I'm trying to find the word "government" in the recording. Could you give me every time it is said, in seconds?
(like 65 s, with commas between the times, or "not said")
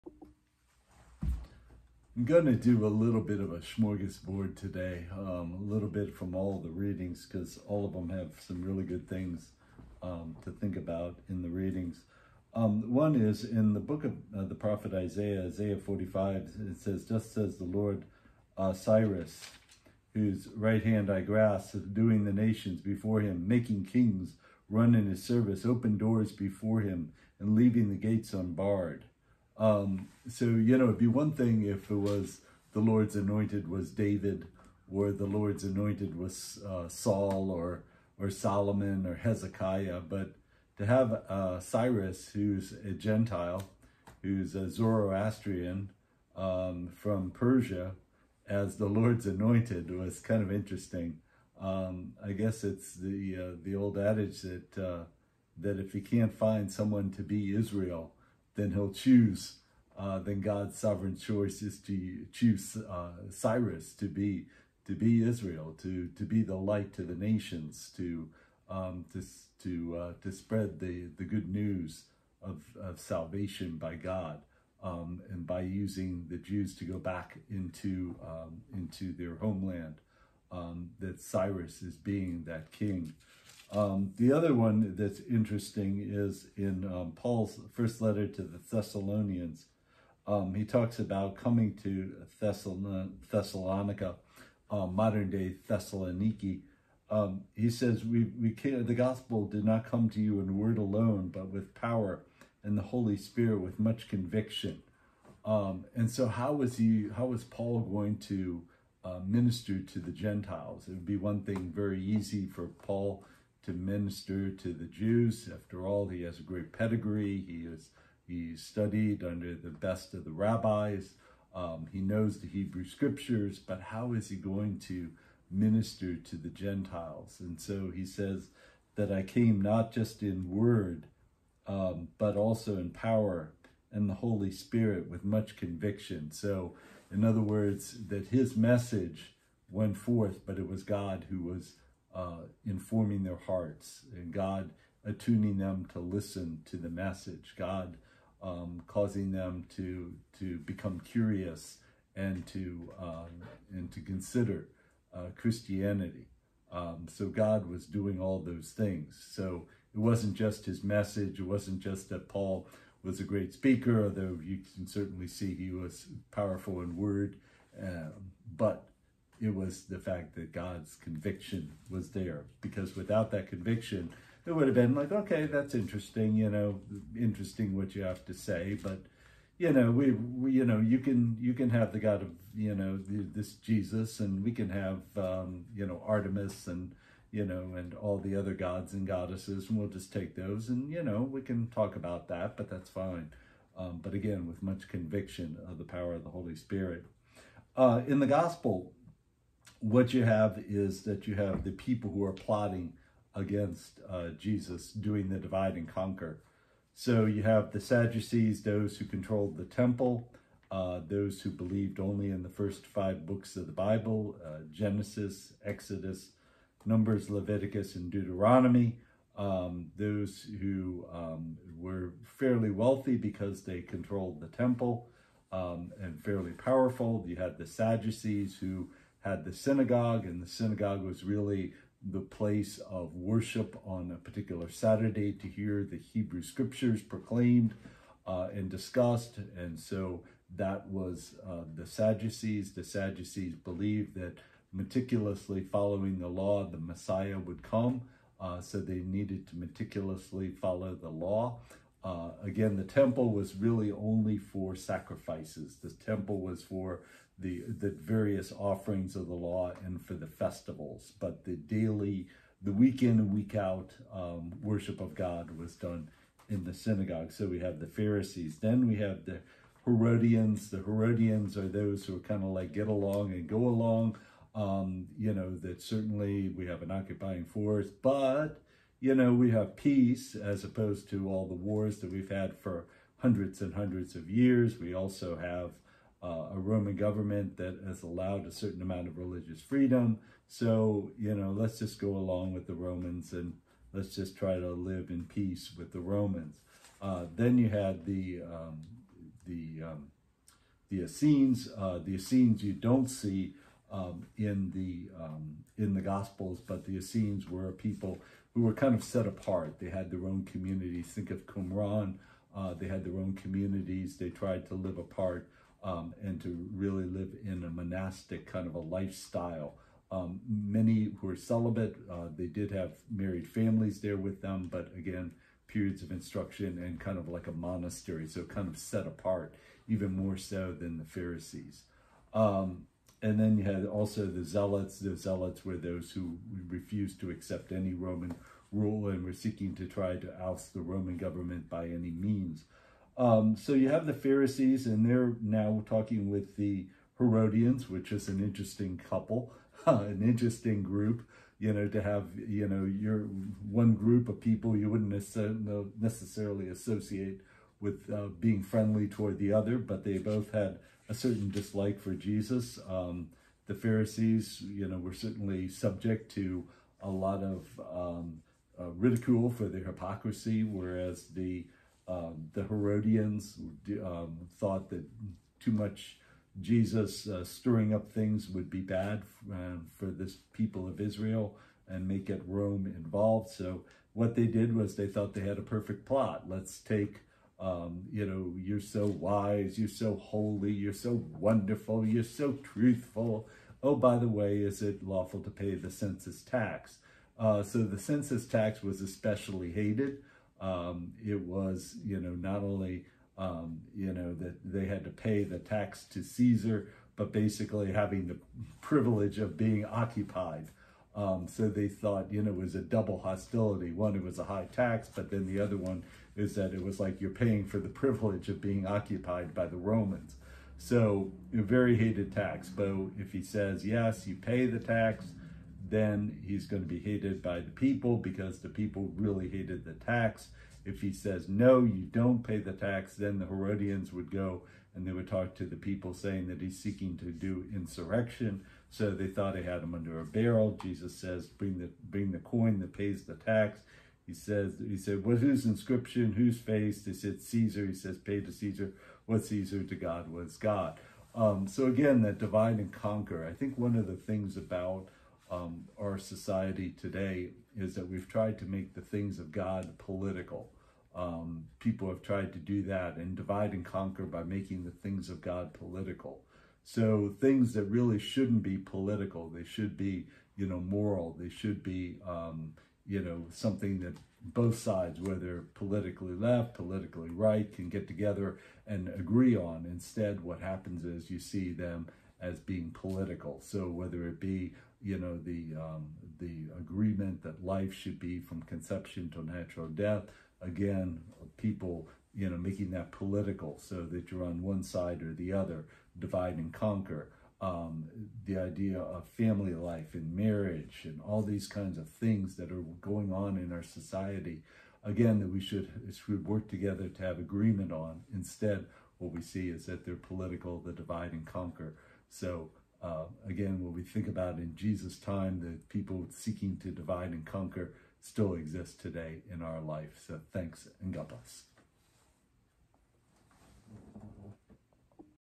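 286 s, 341 s.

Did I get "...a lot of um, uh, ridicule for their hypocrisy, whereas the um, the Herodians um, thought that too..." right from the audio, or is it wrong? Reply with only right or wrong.
right.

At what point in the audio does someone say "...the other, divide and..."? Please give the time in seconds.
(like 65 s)
495 s.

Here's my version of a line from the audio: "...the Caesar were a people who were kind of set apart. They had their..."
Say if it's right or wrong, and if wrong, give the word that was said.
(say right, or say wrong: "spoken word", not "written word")
wrong: "Essenes", not "Caesar".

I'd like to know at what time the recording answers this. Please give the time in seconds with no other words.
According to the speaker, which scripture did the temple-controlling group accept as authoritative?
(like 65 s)
212 s.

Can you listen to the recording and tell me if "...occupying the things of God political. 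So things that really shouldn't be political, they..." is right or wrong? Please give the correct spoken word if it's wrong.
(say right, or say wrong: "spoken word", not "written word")
wrong: "making", not "occupying".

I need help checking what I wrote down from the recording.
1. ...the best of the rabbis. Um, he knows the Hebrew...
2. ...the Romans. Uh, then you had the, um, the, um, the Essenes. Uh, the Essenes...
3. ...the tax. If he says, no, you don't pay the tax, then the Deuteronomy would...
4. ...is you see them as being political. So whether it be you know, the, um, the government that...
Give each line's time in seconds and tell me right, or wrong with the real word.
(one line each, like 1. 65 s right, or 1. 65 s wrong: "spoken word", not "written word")
1. 119 s right
2. 295 s right
3. 429 s wrong: "Herodians", not "Deuteronomy"
4. 481 s wrong: "agreement", not "government".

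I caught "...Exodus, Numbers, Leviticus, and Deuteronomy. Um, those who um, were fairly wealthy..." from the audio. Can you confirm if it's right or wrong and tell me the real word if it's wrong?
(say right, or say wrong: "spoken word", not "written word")
right.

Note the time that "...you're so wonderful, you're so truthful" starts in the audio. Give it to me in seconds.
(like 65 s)
390 s.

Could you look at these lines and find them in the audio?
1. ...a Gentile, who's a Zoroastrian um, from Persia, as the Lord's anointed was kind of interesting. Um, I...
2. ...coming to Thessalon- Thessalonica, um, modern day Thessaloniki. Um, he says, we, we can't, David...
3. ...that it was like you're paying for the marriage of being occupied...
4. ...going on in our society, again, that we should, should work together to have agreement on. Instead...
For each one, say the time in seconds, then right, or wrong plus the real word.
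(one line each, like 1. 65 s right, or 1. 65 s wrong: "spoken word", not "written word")
1. 42 s right
2. 91 s wrong: "The", not "David"
3. 416 s wrong: "privilege", not "marriage"
4. 503 s right.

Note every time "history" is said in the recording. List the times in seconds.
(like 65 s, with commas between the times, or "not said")
not said.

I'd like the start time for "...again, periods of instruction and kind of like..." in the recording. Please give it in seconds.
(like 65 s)
324 s.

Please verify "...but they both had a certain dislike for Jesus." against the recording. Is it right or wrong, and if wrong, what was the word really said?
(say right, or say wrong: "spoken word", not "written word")
right.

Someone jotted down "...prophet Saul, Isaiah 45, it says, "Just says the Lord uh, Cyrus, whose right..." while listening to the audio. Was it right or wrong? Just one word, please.
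wrong.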